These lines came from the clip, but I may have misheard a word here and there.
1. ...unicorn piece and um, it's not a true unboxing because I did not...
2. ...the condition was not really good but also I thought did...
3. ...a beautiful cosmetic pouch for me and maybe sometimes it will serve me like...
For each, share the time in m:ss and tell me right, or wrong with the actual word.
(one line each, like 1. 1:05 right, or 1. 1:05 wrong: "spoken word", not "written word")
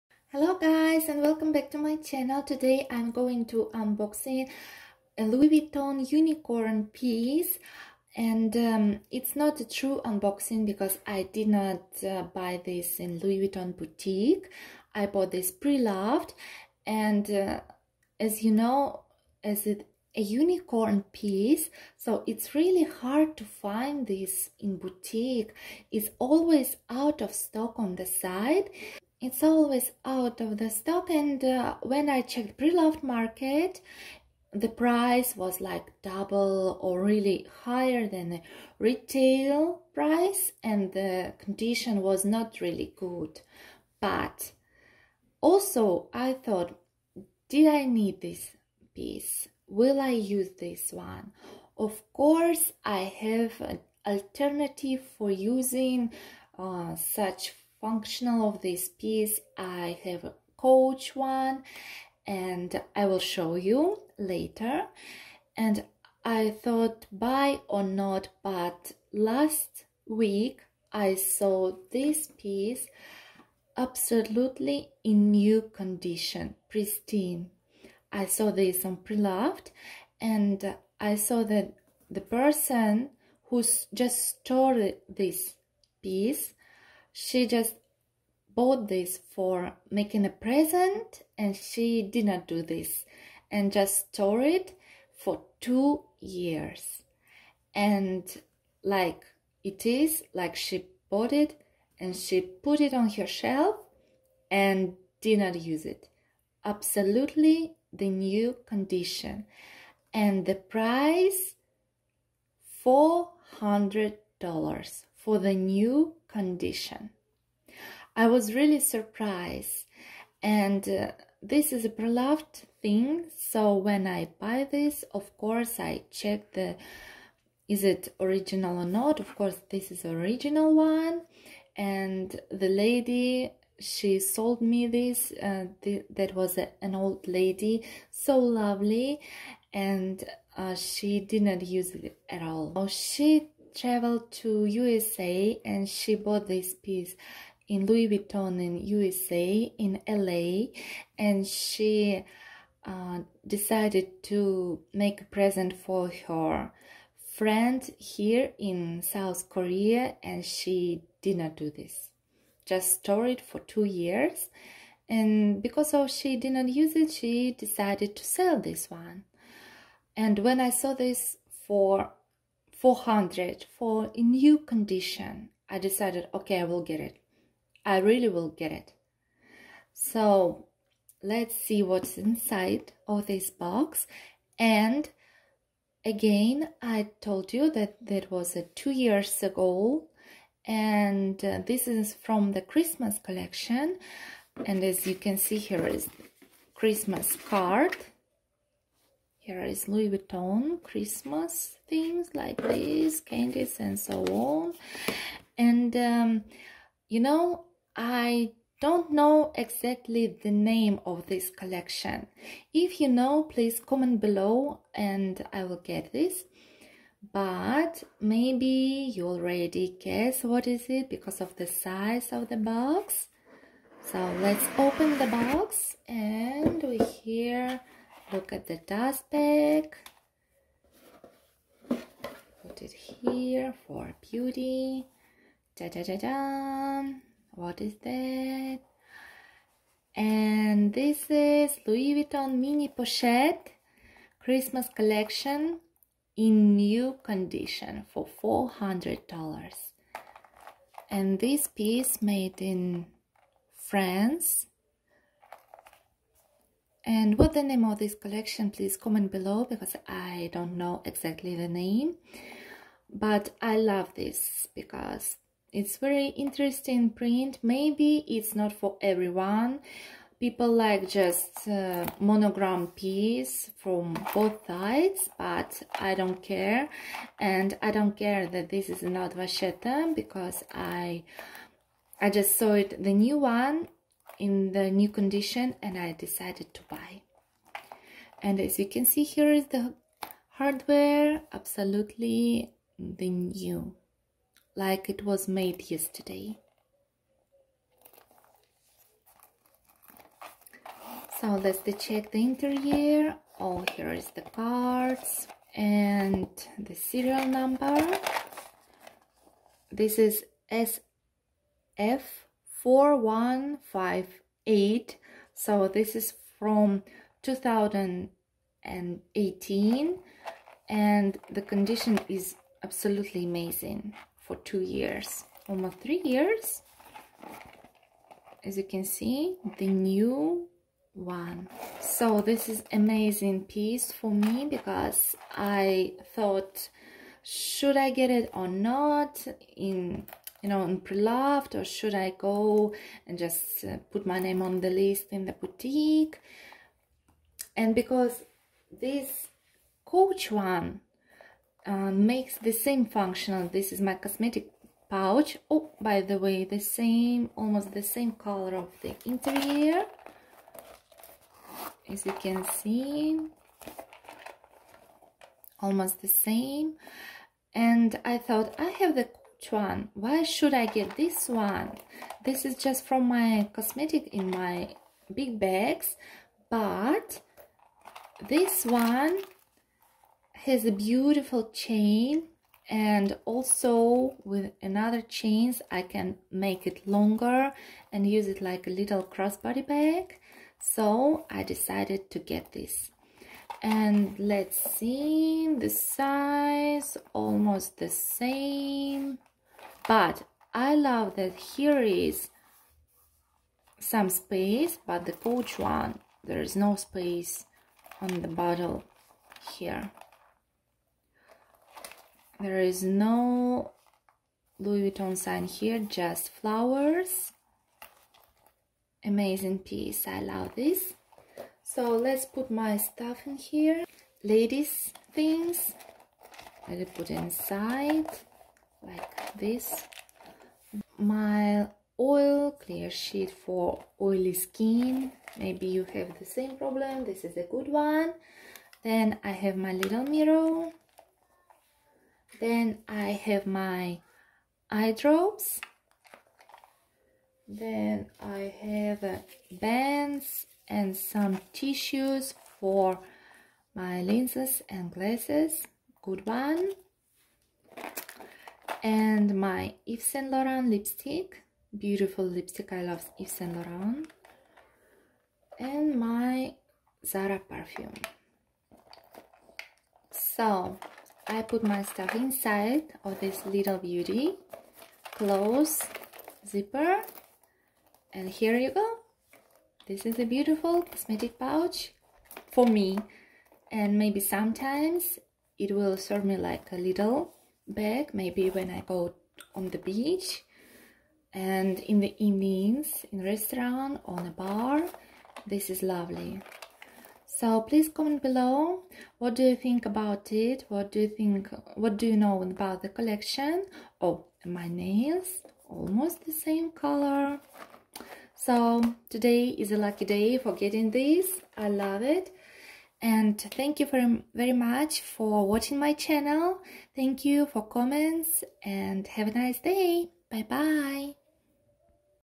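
1. 0:06 right
2. 0:40 right
3. 8:00 right.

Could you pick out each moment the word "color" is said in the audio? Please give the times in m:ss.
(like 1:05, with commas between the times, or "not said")
5:58, 8:26.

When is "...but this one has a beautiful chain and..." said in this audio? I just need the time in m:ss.
6:16.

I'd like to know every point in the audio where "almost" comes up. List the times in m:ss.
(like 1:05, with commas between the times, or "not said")
5:25, 5:57, 6:05, 6:37, 8:25.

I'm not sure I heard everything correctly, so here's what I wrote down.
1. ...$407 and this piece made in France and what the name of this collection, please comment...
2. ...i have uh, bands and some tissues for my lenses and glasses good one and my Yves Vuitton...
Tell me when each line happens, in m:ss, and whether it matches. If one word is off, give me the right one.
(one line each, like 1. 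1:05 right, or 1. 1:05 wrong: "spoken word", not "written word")
1. 4:08 wrong: "400", not "407"
2. 7:28 wrong: "Saint", not "Vuitton".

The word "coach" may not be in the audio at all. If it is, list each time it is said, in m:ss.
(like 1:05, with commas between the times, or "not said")
1:00, 5:50, 6:45.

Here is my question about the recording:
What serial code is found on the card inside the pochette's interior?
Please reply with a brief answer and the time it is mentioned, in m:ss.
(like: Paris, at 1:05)
SF 4158, at 5:10.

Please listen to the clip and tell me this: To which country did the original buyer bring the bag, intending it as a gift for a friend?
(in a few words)
South Korea.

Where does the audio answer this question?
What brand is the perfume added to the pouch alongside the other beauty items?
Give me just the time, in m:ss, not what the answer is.
7:47.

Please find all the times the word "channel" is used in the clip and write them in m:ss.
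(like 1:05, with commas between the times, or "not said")
0:01, 8:36.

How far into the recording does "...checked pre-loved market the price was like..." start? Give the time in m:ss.
0:32.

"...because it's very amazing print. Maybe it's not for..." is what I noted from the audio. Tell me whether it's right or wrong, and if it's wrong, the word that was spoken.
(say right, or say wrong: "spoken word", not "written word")
wrong: "interesting", not "amazing".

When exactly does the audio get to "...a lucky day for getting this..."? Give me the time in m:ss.
8:29.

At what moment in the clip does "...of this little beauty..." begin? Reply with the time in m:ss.
7:53.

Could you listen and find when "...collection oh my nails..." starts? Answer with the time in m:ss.
8:23.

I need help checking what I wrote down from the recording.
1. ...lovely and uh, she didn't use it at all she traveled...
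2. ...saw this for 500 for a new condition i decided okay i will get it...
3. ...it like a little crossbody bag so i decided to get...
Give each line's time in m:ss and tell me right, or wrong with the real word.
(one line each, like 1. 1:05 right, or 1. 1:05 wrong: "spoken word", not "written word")
1. 2:18 right
2. 2:50 wrong: "400", not "500"
3. 6:28 right.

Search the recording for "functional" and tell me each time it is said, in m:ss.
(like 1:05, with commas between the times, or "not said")
0:57, 5:53.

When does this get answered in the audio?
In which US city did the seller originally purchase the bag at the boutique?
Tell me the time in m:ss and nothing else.
2:30.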